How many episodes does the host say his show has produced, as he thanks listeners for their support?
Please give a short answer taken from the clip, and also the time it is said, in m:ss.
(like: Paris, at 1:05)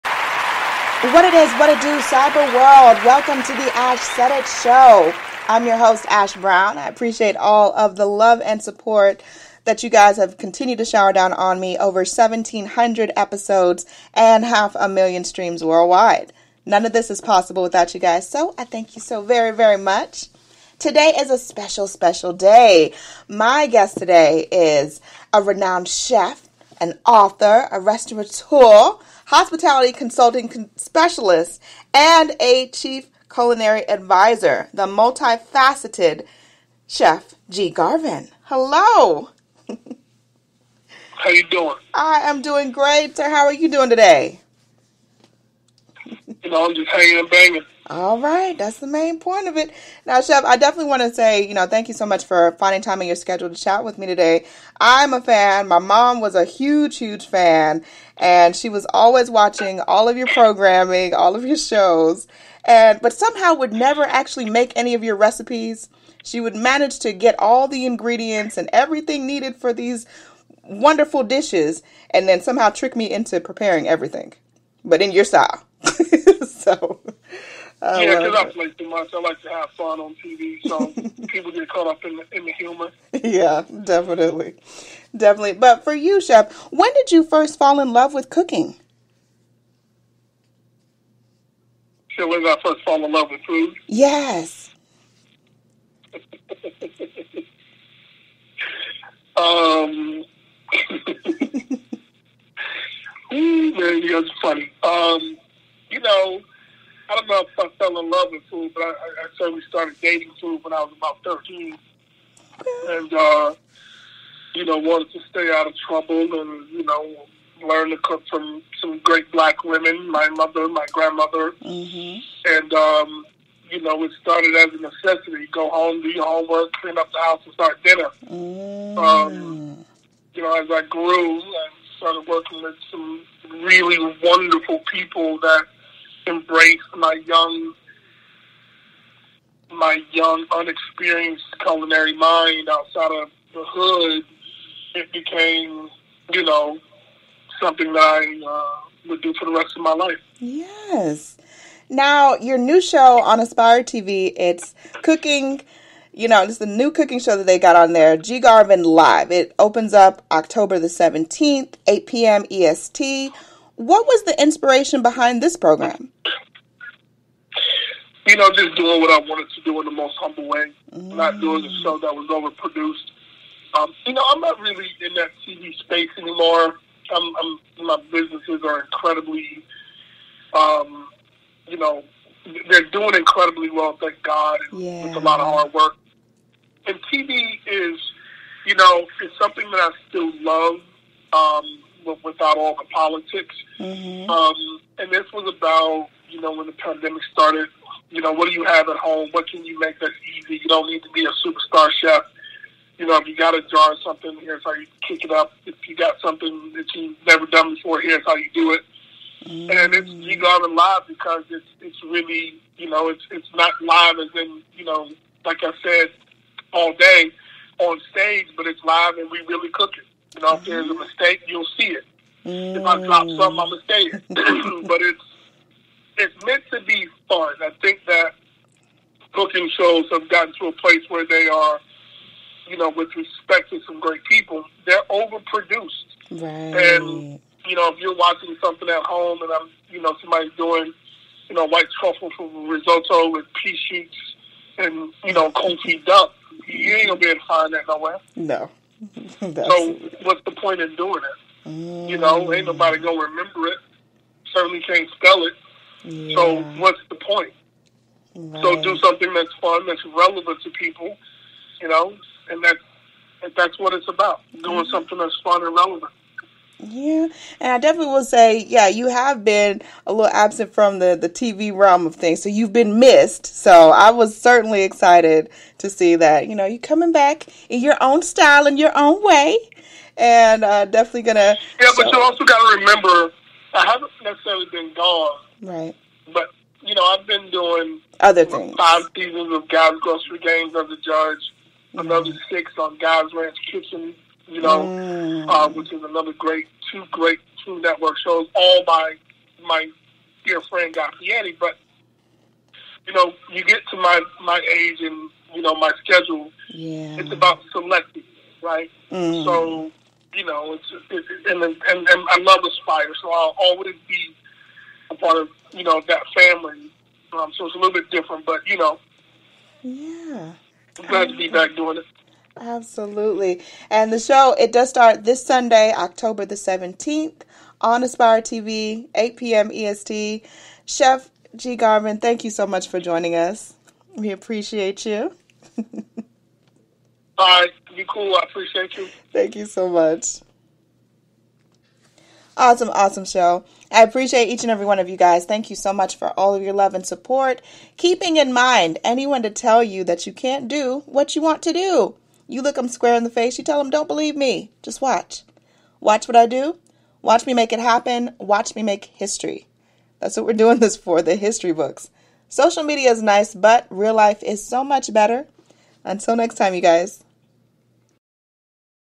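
1,700, at 0:12.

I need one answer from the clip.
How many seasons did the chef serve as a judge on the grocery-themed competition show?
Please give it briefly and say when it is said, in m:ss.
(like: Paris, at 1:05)
Five, at 4:48.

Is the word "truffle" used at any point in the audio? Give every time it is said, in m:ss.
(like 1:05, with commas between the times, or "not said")
4:01.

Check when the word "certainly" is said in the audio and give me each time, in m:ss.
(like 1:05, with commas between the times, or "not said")
1:49, 4:14, 4:34.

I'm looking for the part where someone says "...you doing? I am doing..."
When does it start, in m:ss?
0:41.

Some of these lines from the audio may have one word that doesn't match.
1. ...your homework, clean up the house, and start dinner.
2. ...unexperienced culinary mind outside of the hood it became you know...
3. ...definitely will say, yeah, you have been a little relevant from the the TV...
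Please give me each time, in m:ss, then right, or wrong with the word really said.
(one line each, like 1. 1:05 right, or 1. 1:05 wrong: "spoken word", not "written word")
1. 2:06 right
2. 2:20 right
3. 4:27 wrong: "absent", not "relevant".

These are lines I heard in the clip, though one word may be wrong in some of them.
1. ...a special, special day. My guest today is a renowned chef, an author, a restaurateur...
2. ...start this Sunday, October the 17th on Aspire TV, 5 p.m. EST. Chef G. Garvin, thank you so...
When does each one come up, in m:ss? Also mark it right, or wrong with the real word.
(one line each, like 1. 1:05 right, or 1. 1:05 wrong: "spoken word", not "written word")
1. 0:21 right
2. 5:24 wrong: "8", not "5".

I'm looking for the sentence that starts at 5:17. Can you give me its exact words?
Um, so it's a little bit different, but you know, yeah.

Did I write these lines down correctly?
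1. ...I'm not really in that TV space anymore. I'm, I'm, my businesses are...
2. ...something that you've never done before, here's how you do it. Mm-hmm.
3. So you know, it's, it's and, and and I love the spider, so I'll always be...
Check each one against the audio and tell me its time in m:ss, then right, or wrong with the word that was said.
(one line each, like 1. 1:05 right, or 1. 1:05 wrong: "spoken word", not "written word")
1. 2:54 right
2. 3:26 right
3. 5:09 right.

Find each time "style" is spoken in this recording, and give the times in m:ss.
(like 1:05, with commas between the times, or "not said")
1:15, 4:38.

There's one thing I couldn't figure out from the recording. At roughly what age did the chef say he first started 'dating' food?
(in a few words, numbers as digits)
13.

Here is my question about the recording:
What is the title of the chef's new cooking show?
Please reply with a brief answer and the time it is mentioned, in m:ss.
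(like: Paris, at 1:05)
G Garvin Live, at 2:38.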